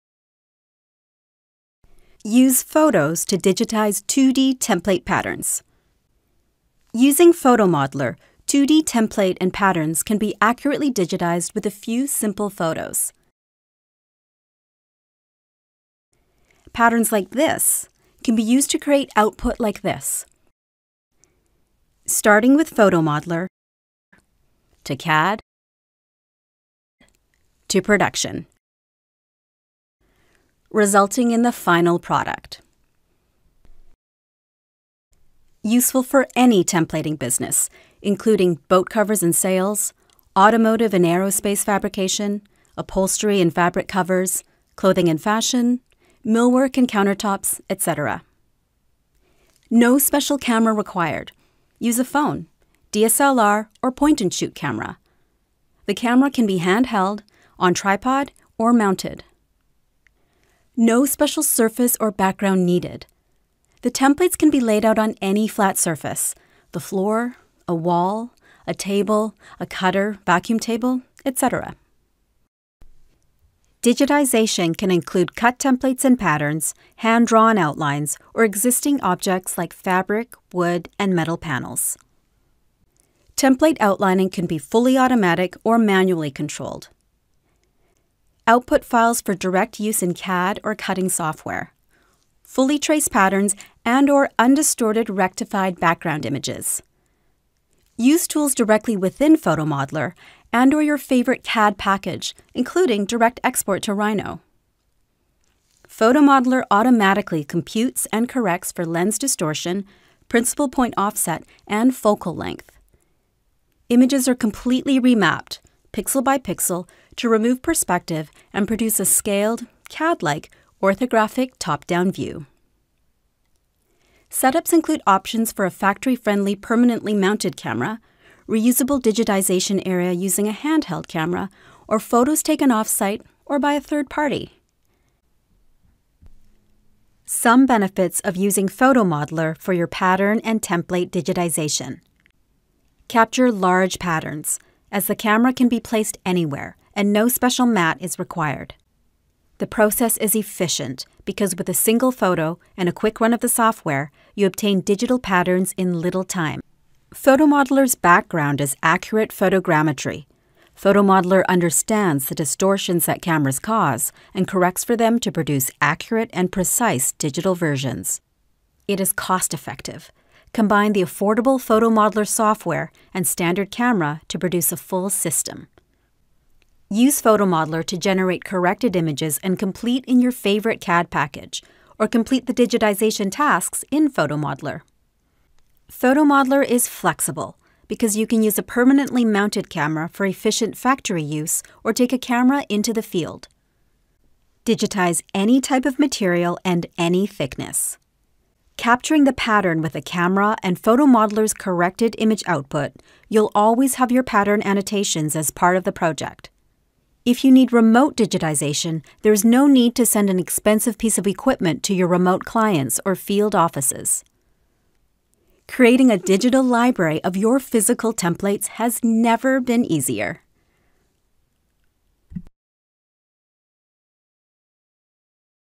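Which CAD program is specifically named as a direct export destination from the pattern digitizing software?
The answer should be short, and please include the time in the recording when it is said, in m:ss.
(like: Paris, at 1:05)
Rhino, at 1:43.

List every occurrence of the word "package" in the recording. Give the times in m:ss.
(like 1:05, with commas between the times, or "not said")
1:41, 3:01.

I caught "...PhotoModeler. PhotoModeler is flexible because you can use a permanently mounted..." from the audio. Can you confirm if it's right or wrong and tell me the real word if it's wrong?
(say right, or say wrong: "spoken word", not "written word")
right.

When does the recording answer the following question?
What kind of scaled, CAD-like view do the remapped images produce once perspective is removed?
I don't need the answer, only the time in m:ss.
2:00.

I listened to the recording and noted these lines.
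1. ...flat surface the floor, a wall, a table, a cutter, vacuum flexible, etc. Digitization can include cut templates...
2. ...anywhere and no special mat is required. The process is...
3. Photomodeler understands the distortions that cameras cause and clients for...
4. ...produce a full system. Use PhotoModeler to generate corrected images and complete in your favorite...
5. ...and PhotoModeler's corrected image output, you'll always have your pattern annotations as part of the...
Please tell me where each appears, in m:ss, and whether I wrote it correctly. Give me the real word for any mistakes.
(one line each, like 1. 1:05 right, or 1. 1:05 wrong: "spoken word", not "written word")
1. 1:05 wrong: "table", not "flexible"
2. 2:26 right
3. 2:40 wrong: "corrects", not "clients"
4. 2:54 right
5. 3:20 right.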